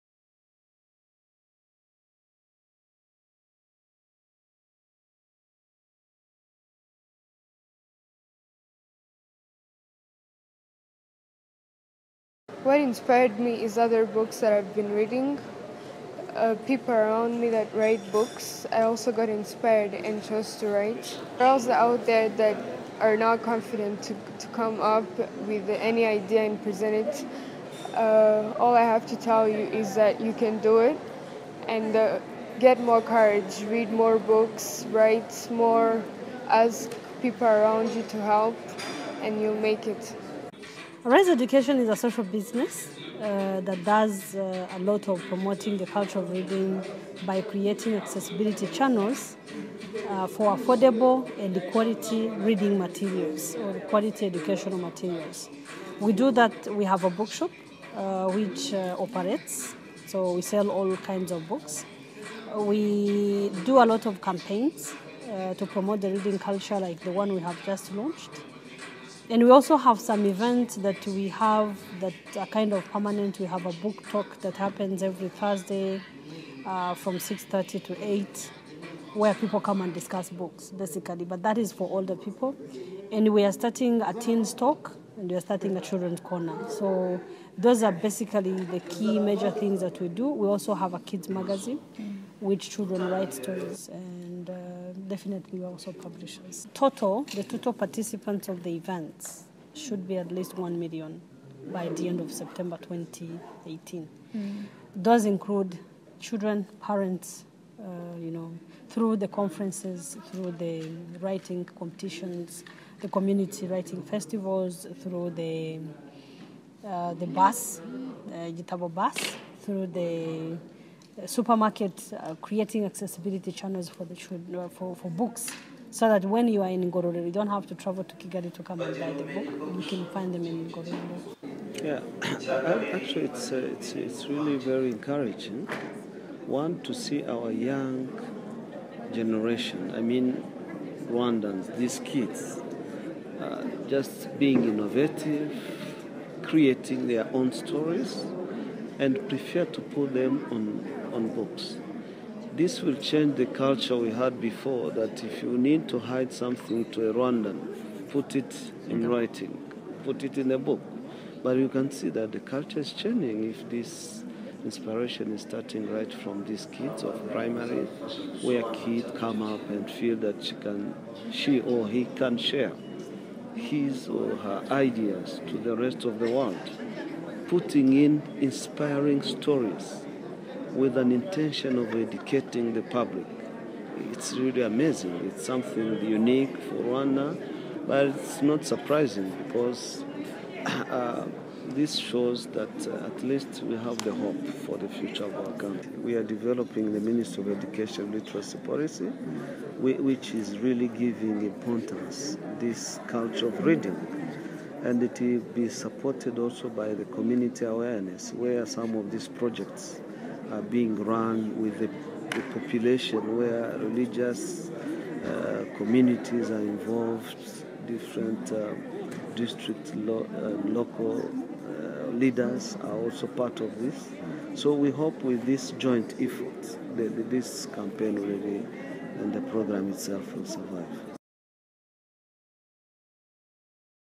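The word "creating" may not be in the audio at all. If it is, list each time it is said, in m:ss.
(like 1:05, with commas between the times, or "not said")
0:47, 2:02, 2:26.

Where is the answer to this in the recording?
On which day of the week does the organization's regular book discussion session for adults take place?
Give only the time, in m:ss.
1:15.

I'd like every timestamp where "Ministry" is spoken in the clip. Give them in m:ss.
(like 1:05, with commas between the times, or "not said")
3:16.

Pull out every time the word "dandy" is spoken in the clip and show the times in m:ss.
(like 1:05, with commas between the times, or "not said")
not said.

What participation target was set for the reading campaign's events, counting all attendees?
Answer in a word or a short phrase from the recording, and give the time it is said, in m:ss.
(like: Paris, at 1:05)
1 million, at 1:40.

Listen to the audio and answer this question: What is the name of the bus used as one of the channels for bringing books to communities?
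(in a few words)
Igitabo bus.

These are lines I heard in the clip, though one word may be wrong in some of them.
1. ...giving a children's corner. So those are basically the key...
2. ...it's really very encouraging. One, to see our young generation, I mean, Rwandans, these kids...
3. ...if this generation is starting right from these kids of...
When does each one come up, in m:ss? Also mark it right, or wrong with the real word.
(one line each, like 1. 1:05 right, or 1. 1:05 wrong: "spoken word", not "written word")
1. 1:25 wrong: "starting", not "giving"
2. 2:13 right
3. 2:43 wrong: "inspiration", not "generation".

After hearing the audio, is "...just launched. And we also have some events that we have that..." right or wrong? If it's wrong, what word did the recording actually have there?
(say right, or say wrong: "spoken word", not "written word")
right.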